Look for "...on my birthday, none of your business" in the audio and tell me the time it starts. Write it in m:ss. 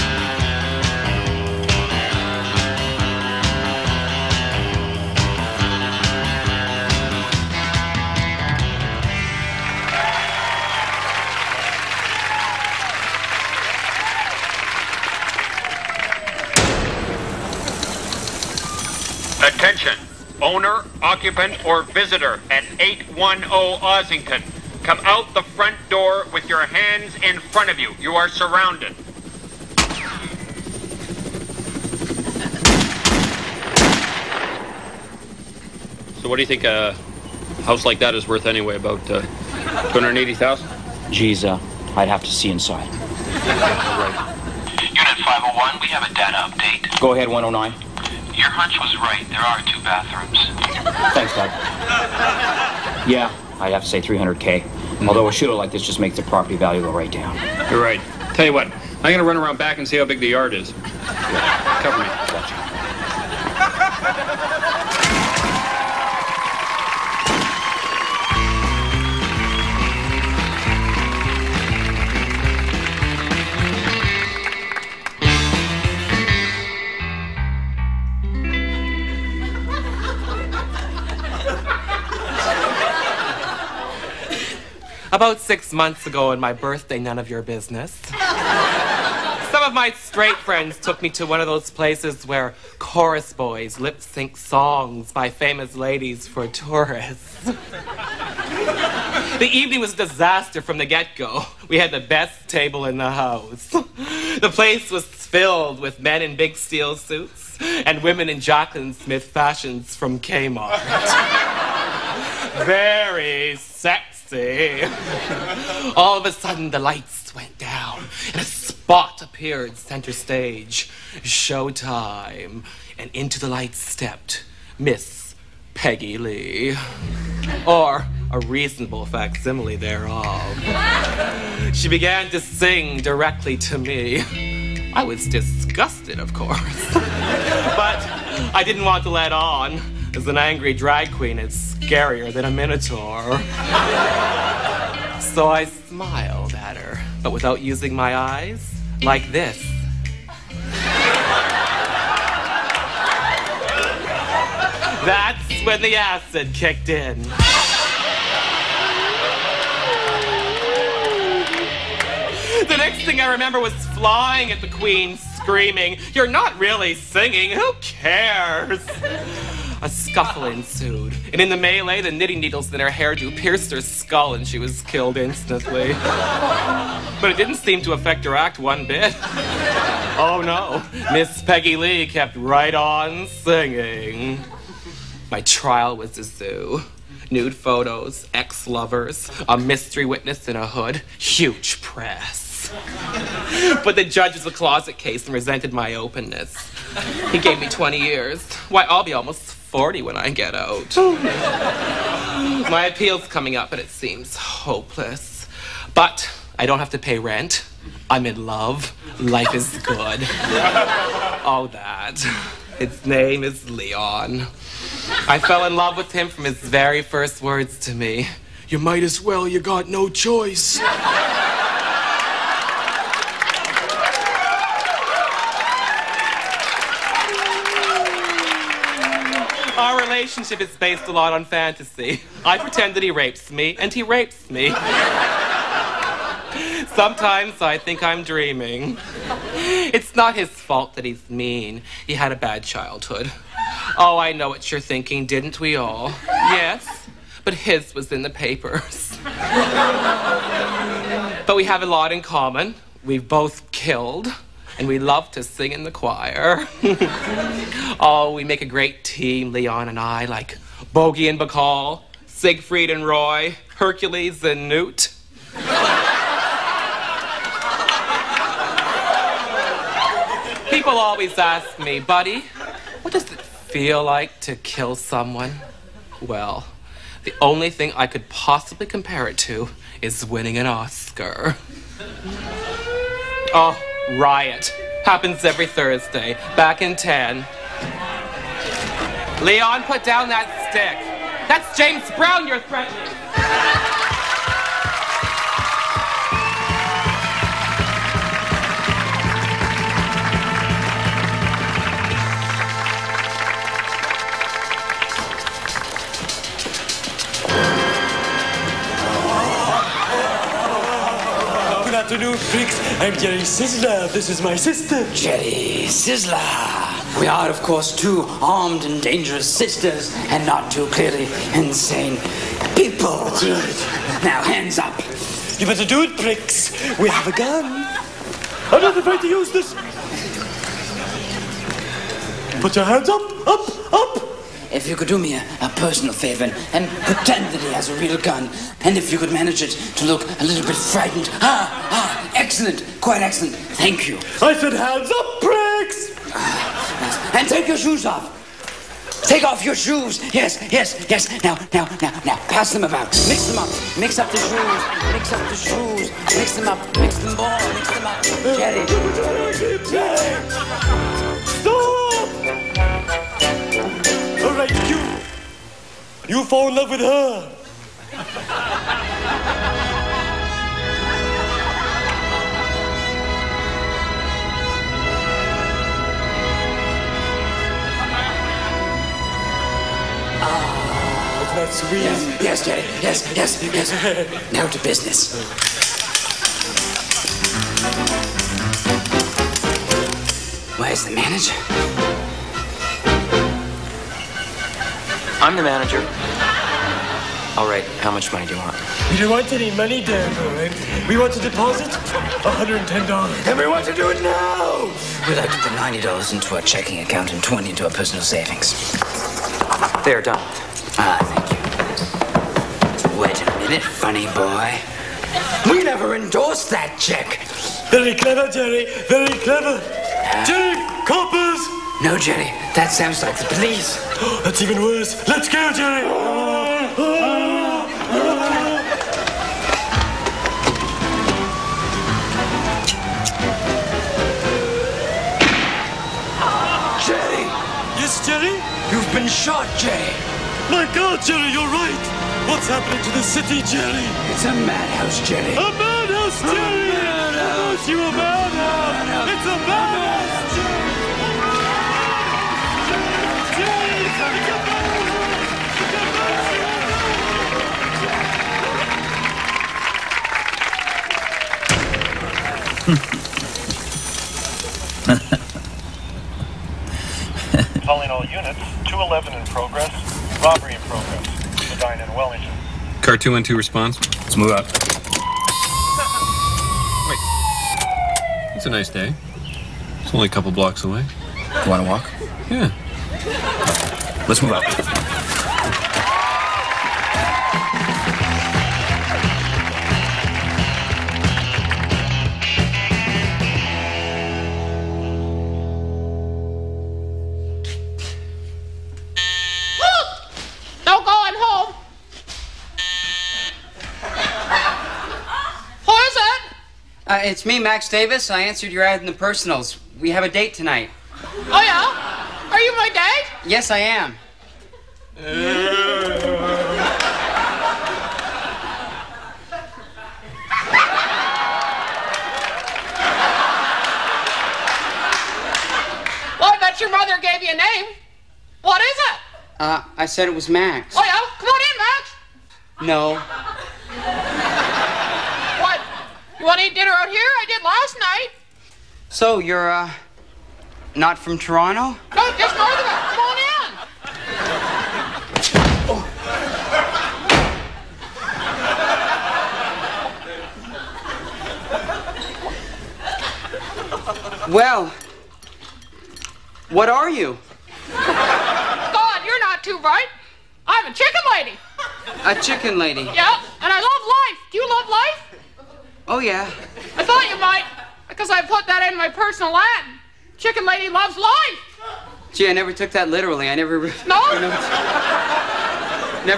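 1:26.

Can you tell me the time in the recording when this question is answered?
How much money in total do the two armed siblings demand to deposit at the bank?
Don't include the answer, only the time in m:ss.
6:42.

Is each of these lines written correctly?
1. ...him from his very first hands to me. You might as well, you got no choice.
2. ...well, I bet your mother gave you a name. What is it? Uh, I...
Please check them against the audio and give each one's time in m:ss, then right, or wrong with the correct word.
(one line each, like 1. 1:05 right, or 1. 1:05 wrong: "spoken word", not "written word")
1. 3:36 wrong: "words", not "hands"
2. 8:46 right.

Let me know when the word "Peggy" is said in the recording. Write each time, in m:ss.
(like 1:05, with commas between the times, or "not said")
2:05, 3:01.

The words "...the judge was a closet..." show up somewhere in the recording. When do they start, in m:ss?
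3:13.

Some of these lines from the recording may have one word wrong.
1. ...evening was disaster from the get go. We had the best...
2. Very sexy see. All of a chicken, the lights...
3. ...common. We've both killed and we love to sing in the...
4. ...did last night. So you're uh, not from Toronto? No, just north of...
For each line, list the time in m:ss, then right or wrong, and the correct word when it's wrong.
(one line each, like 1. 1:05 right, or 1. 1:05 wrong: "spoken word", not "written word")
1. 1:39 right
2. 1:52 wrong: "sudden", not "chicken"
3. 4:12 right
4. 8:57 right.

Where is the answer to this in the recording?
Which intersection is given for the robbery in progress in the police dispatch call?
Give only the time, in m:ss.
7:51.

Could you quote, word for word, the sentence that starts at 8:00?
It's only a couple blocks away.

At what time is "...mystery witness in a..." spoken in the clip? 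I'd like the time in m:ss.
3:09.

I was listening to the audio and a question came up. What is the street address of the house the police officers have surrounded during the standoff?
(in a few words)
810 Ossington.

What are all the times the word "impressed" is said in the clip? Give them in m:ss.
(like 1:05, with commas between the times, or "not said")
not said.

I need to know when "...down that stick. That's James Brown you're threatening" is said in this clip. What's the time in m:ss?
4:50.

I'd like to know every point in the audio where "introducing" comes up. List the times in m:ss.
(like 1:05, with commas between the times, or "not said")
not said.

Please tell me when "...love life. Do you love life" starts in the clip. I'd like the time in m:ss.
9:23.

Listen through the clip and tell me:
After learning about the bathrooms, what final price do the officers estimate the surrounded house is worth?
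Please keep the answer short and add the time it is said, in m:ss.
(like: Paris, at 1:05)
300K, at 0:54.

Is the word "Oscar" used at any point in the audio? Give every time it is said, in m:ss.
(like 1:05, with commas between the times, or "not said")
4:40.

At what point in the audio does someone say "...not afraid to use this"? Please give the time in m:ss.
5:28.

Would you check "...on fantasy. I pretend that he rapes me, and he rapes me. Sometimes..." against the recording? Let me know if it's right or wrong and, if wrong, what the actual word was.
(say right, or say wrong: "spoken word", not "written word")
right.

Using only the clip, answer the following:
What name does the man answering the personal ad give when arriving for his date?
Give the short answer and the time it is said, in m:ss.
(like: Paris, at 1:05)
Max Davis, at 8:27.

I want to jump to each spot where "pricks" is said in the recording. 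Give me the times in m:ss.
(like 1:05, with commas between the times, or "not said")
5:26, 5:45.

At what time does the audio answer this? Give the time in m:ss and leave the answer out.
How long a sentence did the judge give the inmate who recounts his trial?
3:17.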